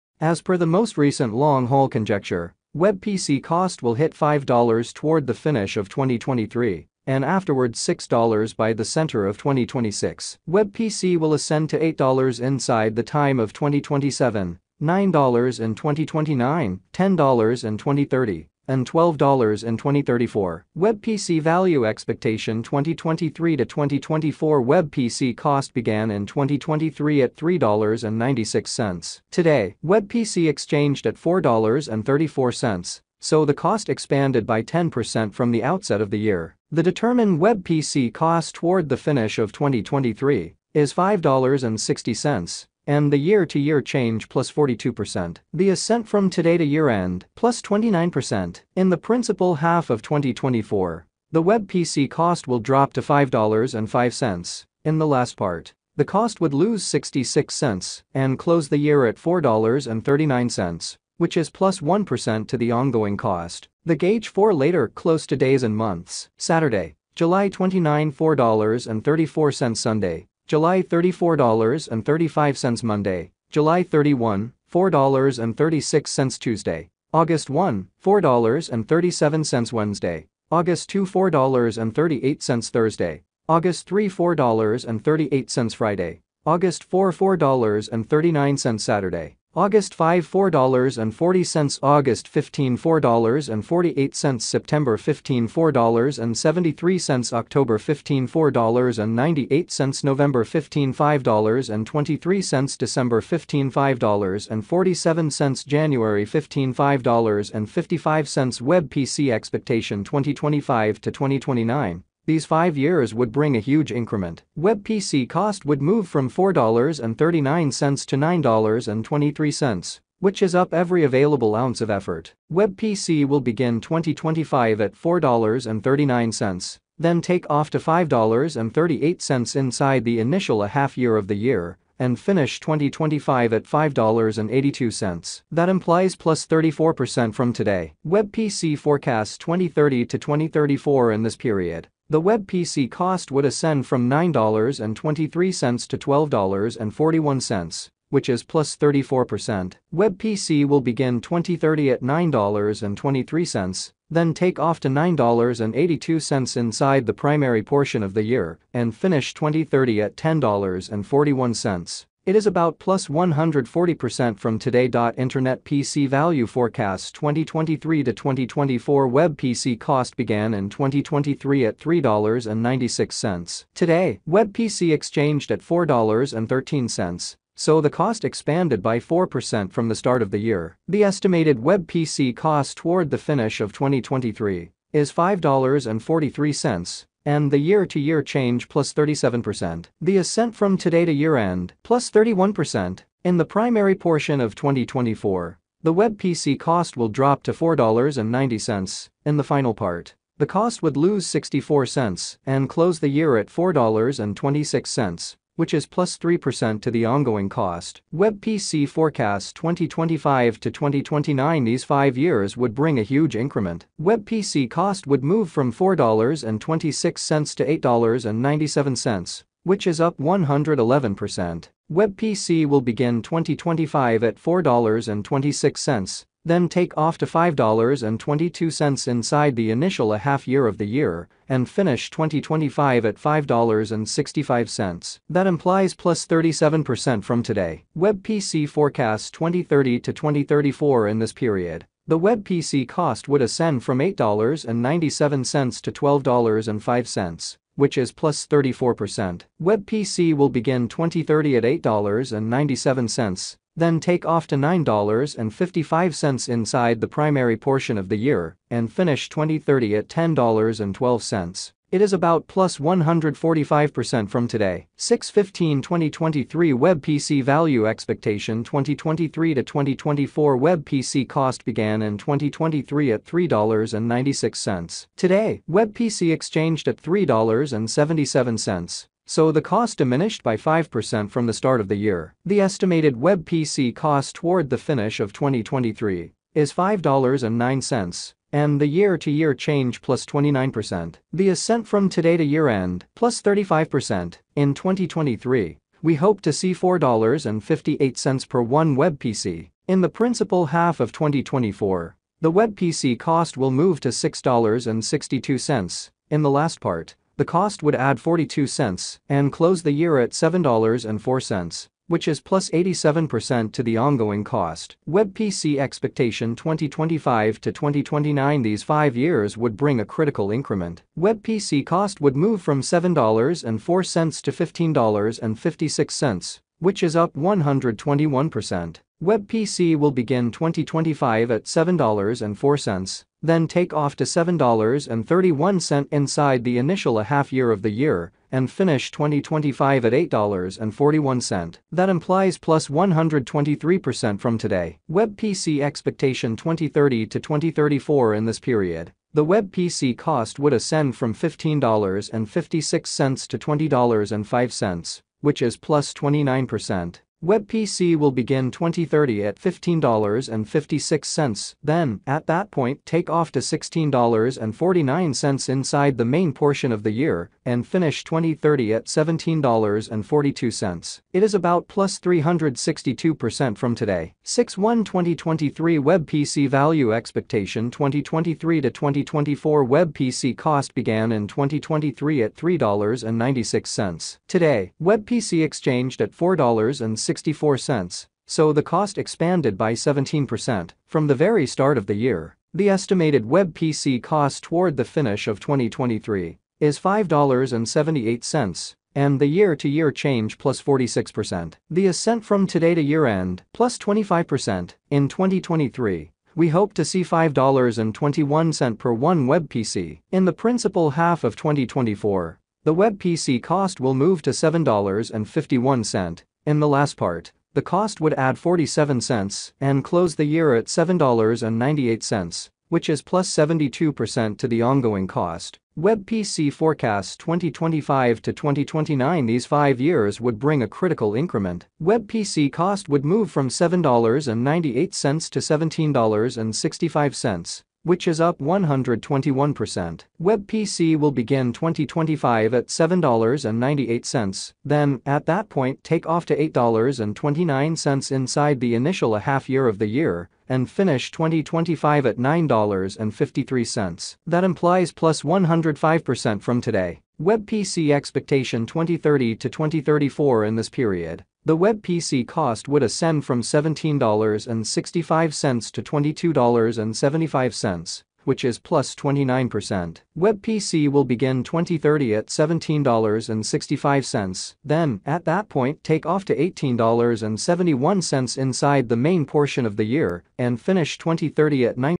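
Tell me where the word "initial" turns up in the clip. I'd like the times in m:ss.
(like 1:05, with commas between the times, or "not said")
2:10, 3:49, 5:36, 7:28.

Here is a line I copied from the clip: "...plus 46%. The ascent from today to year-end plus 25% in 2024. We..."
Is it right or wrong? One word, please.
wrong.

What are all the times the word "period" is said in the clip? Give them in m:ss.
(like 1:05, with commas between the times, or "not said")
2:21, 4:01, 5:48, 7:40.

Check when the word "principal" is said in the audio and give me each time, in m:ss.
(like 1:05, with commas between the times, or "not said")
0:48, 5:00, 6:50.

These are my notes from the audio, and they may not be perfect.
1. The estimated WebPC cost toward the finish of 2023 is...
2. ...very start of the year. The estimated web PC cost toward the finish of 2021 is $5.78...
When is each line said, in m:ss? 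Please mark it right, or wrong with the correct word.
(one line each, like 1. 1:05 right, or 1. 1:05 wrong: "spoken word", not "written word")
1. 4:42 right
2. 6:31 wrong: "2023", not "2021".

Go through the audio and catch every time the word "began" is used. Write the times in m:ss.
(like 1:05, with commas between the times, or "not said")
0:25, 2:50, 4:31, 6:20.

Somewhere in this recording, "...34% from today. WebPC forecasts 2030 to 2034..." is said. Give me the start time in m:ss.
2:16.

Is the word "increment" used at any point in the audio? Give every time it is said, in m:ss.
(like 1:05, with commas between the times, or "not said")
1:53, 3:33, 5:20, 7:11.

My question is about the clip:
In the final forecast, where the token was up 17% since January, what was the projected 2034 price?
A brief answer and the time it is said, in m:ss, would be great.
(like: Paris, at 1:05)
$22.75, at 7:46.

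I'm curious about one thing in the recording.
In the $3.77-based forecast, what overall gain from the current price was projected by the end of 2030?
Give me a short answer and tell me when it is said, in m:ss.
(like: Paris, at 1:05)
362%, at 6:11.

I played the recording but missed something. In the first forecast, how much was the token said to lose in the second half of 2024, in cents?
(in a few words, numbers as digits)
66 cents.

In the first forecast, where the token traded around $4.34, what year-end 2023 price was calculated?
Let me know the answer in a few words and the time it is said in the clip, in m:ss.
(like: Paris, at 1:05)
$5.60, at 0:40.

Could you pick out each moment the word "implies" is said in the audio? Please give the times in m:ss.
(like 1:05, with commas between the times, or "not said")
2:15, 3:55, 5:42, 7:34.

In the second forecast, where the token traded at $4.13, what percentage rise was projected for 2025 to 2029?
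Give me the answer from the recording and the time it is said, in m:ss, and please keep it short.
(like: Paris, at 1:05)
111%, at 3:40.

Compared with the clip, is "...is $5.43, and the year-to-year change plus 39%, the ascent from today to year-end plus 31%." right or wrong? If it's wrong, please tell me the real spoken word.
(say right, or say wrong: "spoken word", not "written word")
wrong: "37", not "39".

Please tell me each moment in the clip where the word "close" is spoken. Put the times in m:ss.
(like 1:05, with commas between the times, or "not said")
0:58, 1:04, 3:22, 5:09, 7:00.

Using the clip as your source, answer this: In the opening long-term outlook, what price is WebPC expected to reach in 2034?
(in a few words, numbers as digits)
$12.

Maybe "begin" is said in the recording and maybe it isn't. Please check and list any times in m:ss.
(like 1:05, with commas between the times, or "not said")
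2:03, 2:30, 3:42, 4:10, 5:30, 5:58, 7:21, 7:51.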